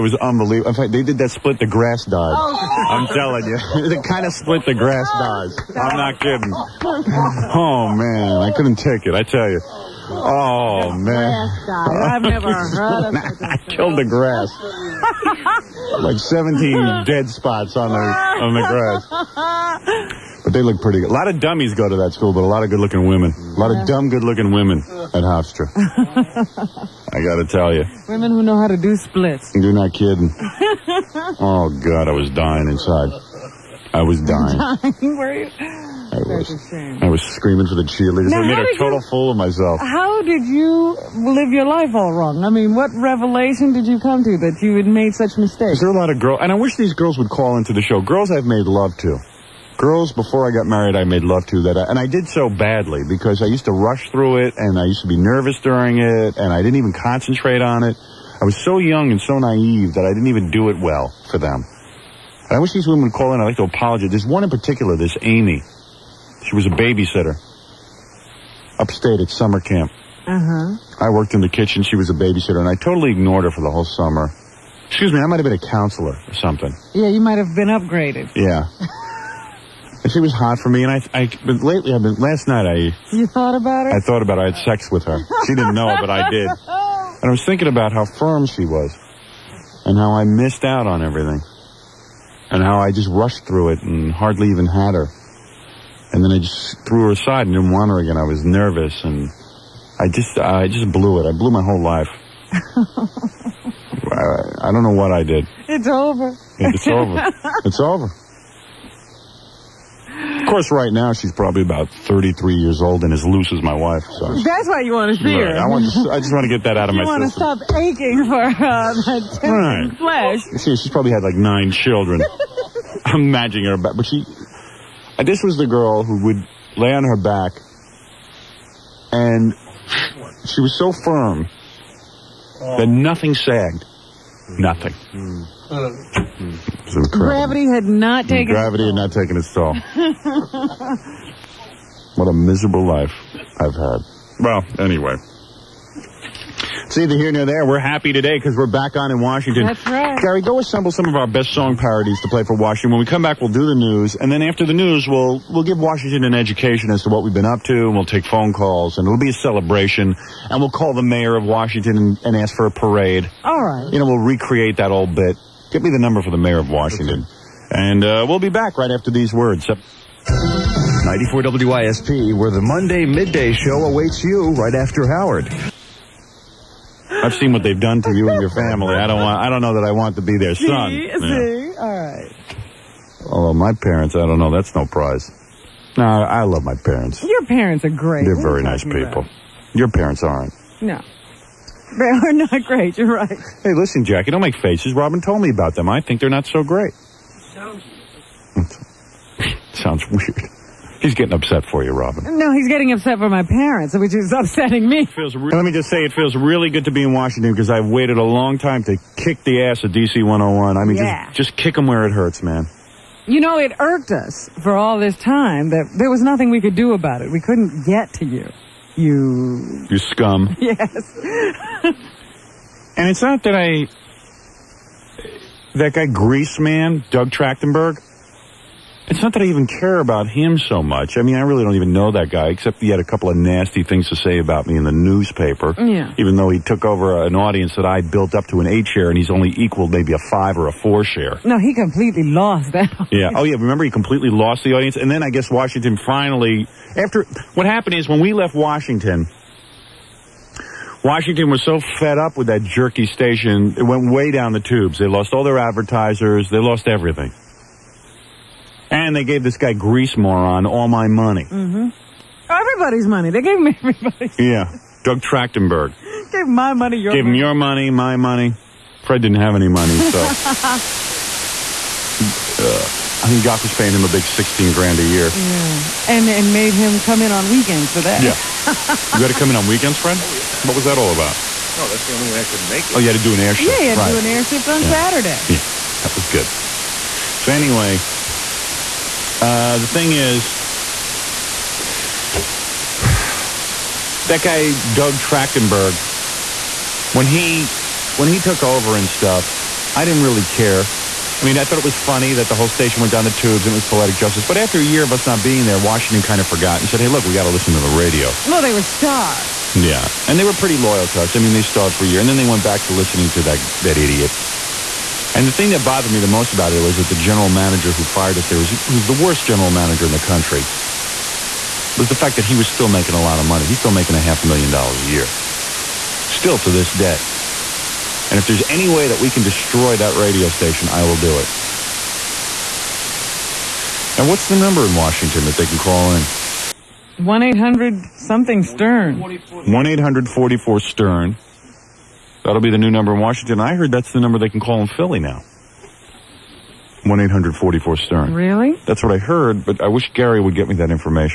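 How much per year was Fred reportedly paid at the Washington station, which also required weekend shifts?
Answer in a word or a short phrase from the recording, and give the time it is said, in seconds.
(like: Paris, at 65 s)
16 grand, at 274 s.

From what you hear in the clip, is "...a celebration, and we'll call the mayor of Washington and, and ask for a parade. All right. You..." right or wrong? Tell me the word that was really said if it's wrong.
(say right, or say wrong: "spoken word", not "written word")
right.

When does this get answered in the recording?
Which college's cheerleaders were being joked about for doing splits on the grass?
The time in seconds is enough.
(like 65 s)
25 s.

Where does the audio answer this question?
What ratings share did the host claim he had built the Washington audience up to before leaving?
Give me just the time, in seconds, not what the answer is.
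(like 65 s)
238 s.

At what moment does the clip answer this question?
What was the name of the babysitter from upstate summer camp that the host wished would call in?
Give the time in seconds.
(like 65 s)
65 s.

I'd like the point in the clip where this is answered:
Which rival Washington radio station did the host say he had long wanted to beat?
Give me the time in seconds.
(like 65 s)
209 s.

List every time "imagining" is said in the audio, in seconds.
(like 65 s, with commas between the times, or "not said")
123 s.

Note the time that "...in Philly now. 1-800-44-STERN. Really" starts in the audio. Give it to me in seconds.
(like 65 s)
344 s.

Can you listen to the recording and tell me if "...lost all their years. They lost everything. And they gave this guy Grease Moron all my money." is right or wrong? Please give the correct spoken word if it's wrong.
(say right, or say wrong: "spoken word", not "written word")
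wrong: "advertisers", not "years".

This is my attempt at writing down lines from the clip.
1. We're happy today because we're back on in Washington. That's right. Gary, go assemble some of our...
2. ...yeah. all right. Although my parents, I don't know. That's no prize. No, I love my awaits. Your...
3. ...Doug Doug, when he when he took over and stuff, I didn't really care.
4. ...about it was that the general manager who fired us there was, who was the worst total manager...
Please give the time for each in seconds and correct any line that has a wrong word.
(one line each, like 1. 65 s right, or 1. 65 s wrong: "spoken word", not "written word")
1. 147 s right
2. 181 s wrong: "parents", not "awaits"
3. 294 s wrong: "Trachtenberg", not "Doug"
4. 316 s wrong: "general", not "total".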